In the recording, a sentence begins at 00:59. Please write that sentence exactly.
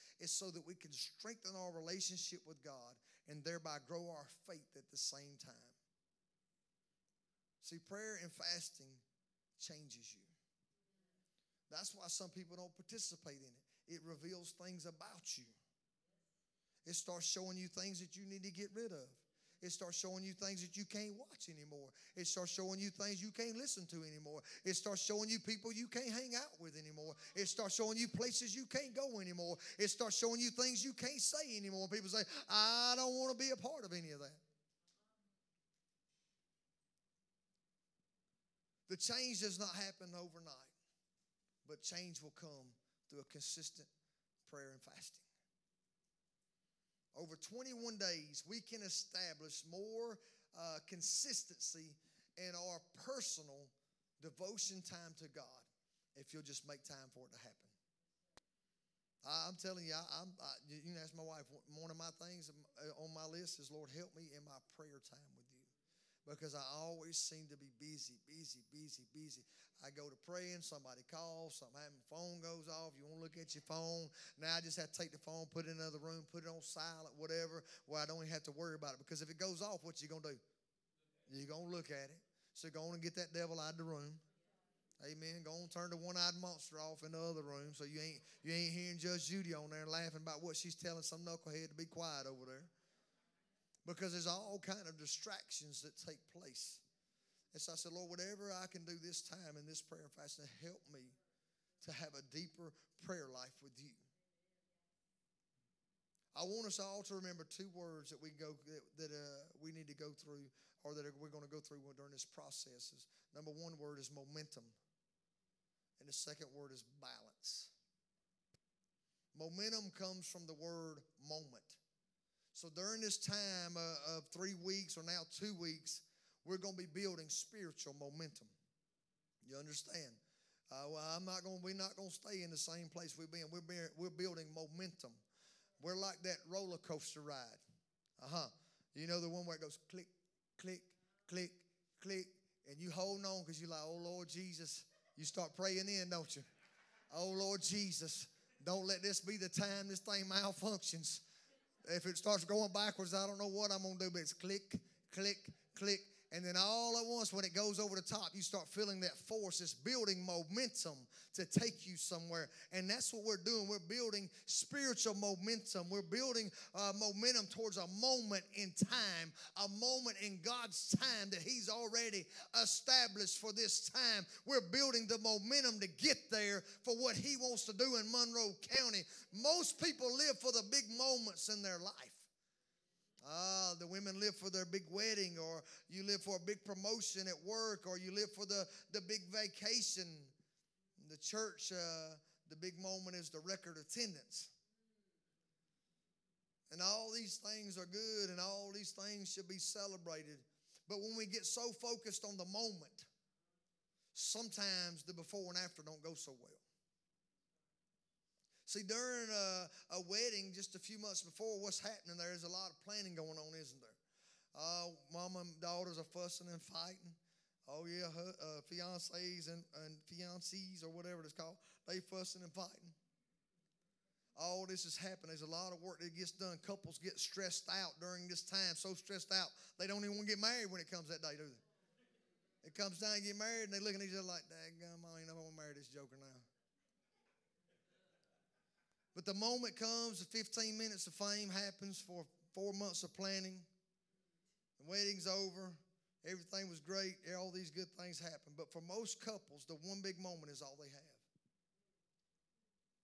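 I, am telling you, I, am you can ask my wife.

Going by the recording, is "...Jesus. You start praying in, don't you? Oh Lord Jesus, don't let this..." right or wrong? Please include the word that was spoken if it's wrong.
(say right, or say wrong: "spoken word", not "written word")
right.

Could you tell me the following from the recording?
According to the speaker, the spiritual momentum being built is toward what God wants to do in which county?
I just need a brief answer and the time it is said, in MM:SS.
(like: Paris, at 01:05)
Monroe County, at 02:58.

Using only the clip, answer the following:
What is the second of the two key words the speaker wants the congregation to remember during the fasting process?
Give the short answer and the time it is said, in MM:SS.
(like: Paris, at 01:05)
Balance, at 01:57.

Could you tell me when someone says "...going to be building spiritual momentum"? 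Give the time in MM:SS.
02:06.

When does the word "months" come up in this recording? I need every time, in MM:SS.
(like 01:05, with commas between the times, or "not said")
03:31, 04:02.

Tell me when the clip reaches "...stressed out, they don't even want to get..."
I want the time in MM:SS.
03:48.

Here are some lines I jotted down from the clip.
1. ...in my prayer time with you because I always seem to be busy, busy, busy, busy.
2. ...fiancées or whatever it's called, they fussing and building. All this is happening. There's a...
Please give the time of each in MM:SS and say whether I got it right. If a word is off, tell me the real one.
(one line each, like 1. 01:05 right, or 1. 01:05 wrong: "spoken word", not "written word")
1. 01:04 right
2. 03:40 wrong: "fighting", not "building".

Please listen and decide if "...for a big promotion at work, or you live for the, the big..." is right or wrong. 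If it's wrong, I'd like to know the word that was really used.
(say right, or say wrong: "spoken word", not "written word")
right.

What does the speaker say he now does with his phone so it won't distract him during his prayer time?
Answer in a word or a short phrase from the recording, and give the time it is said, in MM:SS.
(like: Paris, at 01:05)
Put it in another room, at 01:15.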